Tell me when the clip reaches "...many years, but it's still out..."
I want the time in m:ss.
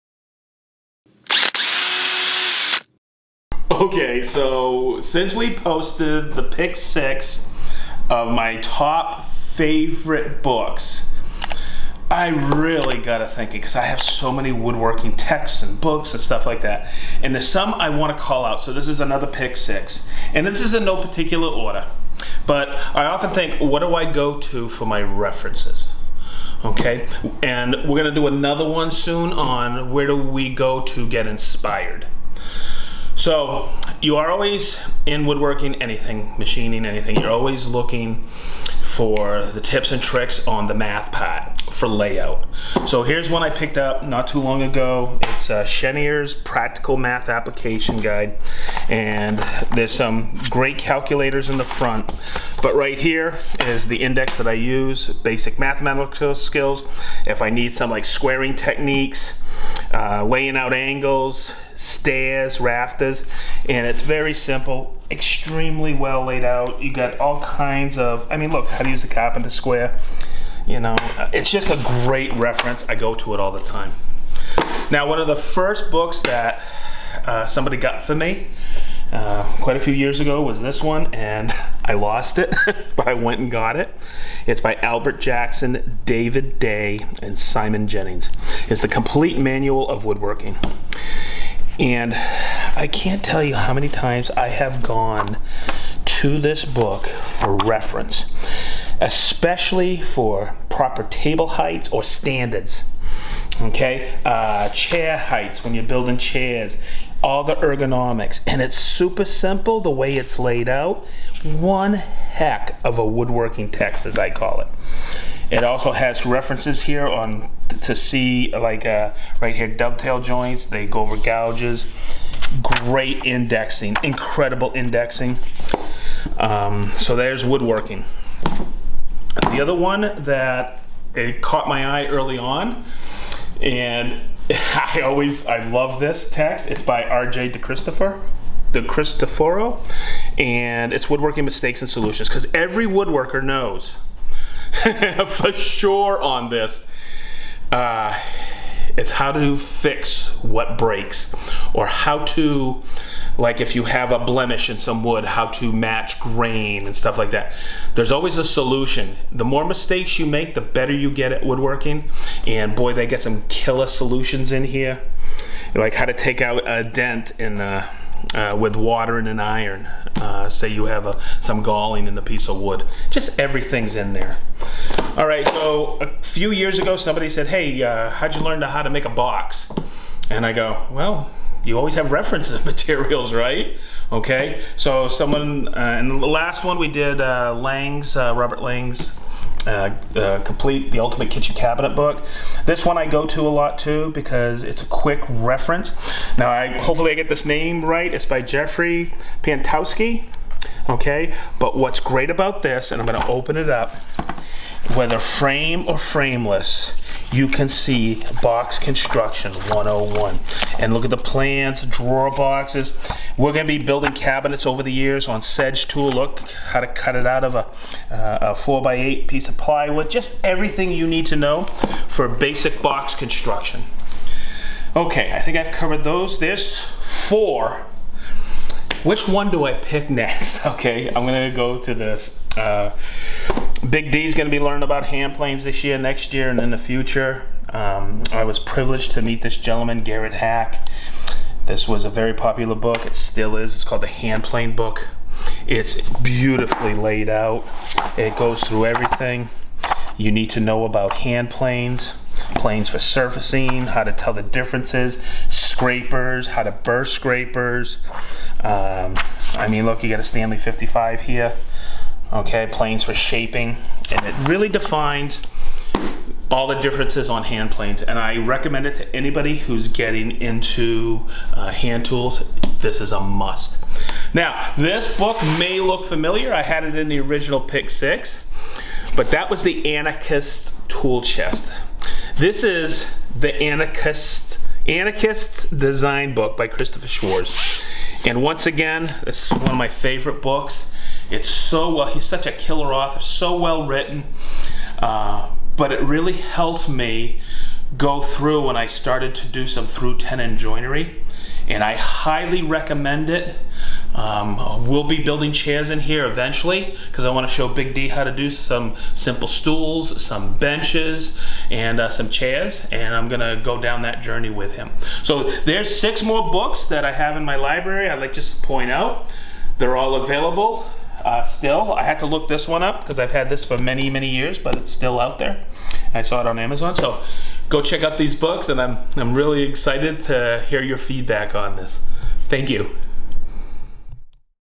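5:24.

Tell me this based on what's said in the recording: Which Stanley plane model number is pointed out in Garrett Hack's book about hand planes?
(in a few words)
55.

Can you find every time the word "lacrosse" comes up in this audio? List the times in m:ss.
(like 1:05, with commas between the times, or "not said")
not said.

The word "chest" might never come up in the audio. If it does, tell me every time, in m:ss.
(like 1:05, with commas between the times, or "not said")
4:41.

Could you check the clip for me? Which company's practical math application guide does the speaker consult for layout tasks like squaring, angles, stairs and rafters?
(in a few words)
Chenier.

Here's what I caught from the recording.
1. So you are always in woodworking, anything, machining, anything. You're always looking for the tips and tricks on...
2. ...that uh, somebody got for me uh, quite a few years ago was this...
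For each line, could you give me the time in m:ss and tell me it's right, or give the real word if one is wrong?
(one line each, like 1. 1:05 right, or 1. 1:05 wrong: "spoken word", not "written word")
1. 0:33 right
2. 1:16 right.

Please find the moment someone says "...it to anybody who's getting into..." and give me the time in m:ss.
4:28.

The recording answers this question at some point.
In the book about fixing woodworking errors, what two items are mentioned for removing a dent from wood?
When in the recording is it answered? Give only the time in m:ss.
2:48.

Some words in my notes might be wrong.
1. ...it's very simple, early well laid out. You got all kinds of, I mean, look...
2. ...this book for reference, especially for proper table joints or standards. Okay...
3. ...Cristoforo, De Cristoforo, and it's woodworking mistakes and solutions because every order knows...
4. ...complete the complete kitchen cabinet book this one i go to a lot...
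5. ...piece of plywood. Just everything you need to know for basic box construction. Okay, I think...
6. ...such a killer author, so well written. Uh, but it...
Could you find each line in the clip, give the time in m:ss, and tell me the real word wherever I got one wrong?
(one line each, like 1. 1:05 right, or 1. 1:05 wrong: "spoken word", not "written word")
1. 1:03 wrong: "extremely", not "early"
2. 1:36 wrong: "heights", not "joints"
3. 2:17 wrong: "woodworker", not "order"
4. 3:10 wrong: "ultimate", not "complete"
5. 3:39 right
6. 4:52 right.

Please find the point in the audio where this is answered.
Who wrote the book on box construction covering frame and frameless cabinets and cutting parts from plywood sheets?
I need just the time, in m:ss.
3:18.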